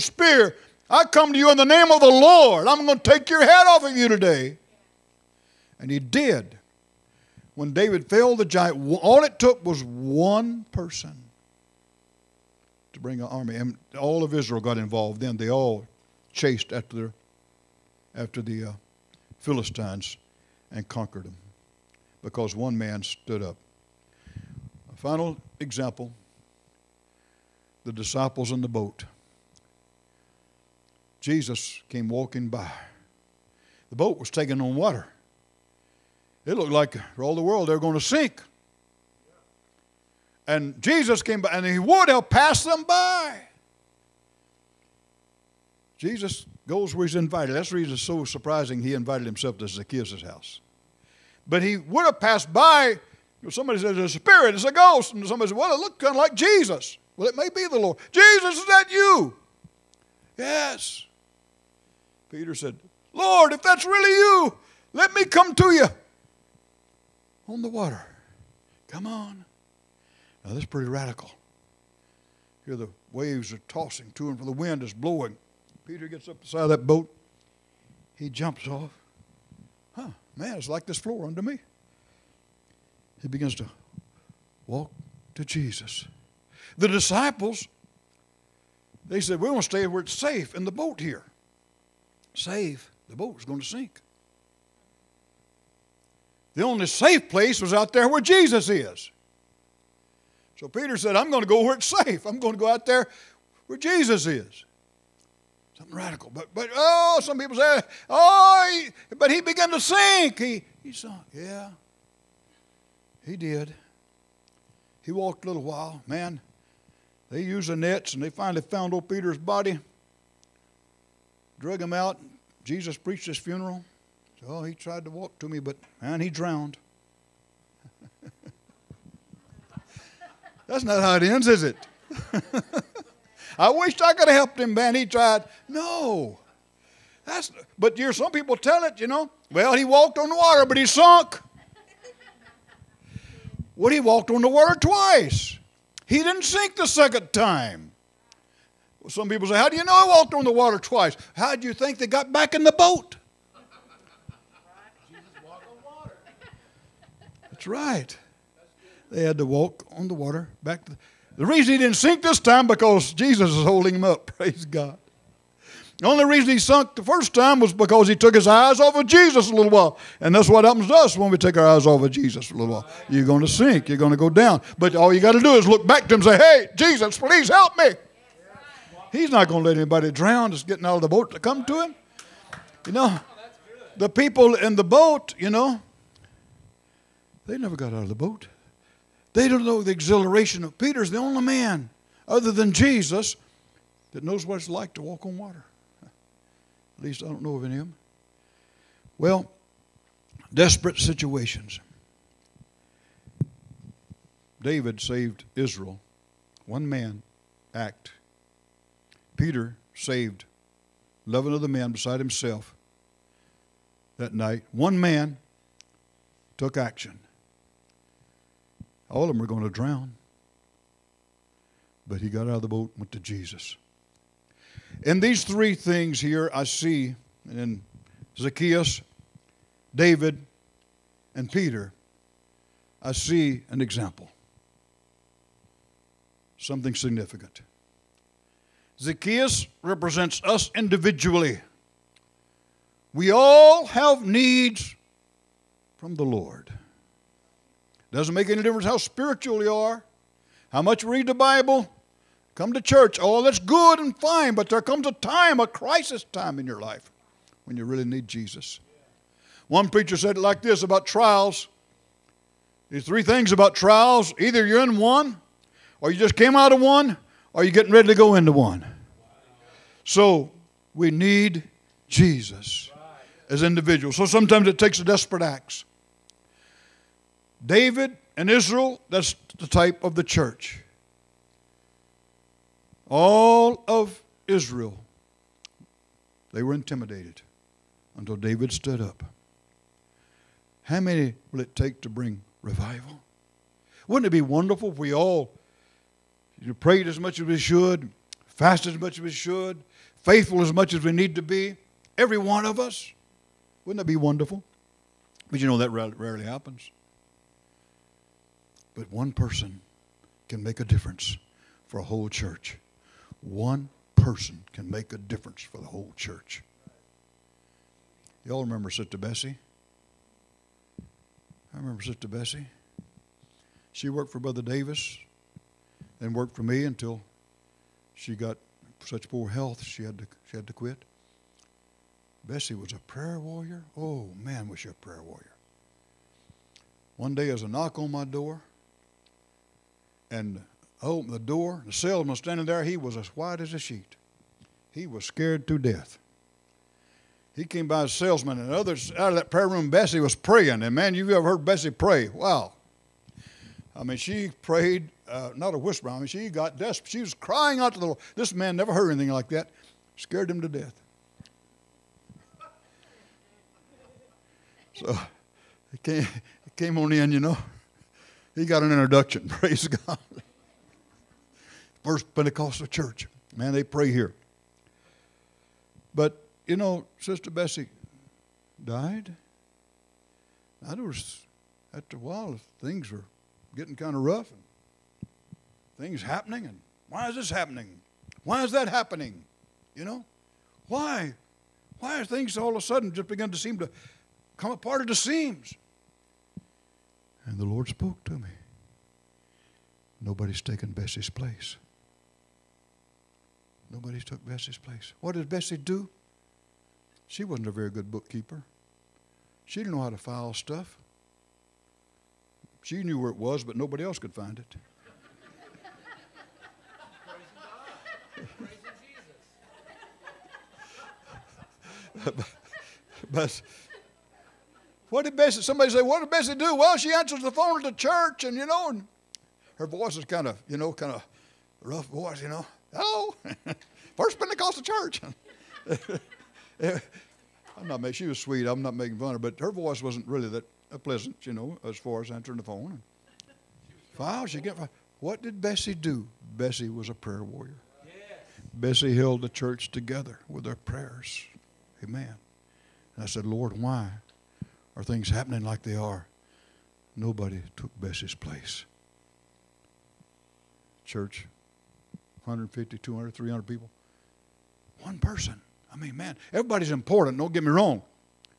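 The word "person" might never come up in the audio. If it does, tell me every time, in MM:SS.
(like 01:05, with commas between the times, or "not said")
00:10, 05:09, 05:14, 07:45.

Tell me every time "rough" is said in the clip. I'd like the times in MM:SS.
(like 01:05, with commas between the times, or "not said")
06:24, 07:11.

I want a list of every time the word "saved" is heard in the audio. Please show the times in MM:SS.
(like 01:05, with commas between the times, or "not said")
03:24, 03:29.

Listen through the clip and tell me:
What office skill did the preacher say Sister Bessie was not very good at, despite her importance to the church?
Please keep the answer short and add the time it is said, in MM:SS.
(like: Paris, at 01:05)
Bookkeeper, at 06:48.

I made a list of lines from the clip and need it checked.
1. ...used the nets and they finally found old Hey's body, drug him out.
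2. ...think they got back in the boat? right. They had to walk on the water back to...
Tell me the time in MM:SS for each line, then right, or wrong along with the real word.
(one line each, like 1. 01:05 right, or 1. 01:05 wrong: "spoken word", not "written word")
1. 01:57 wrong: "Peter", not "Hey"
2. 02:31 right.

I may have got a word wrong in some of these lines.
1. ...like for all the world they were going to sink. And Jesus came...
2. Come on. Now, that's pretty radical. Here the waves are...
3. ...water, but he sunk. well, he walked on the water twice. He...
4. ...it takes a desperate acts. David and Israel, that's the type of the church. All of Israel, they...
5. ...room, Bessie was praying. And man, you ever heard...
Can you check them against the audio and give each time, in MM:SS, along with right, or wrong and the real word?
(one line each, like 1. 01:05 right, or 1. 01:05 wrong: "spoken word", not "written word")
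1. 00:36 right
2. 01:08 right
3. 02:20 right
4. 04:34 right
5. 05:49 right.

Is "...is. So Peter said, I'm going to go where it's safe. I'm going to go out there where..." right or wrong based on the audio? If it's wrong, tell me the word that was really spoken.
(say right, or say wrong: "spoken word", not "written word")
right.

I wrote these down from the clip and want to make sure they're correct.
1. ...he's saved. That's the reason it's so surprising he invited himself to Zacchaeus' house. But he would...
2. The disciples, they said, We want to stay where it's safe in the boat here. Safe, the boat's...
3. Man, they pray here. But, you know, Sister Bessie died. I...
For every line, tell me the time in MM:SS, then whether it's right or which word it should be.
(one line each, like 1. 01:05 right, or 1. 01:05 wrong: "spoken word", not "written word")
1. 00:47 wrong: "invited", not "saved"
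2. 01:26 right
3. 06:13 right.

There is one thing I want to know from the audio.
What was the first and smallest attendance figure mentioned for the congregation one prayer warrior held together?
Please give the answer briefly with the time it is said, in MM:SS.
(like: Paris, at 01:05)
150, at 07:42.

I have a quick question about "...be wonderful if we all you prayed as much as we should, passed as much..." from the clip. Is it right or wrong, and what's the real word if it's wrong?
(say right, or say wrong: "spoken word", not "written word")
wrong: "fasted", not "passed".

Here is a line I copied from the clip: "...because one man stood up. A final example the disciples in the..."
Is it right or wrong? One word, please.
right.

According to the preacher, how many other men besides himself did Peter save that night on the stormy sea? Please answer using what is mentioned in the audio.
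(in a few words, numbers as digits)
11.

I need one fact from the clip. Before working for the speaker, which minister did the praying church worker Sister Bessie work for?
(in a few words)
Brother Davis.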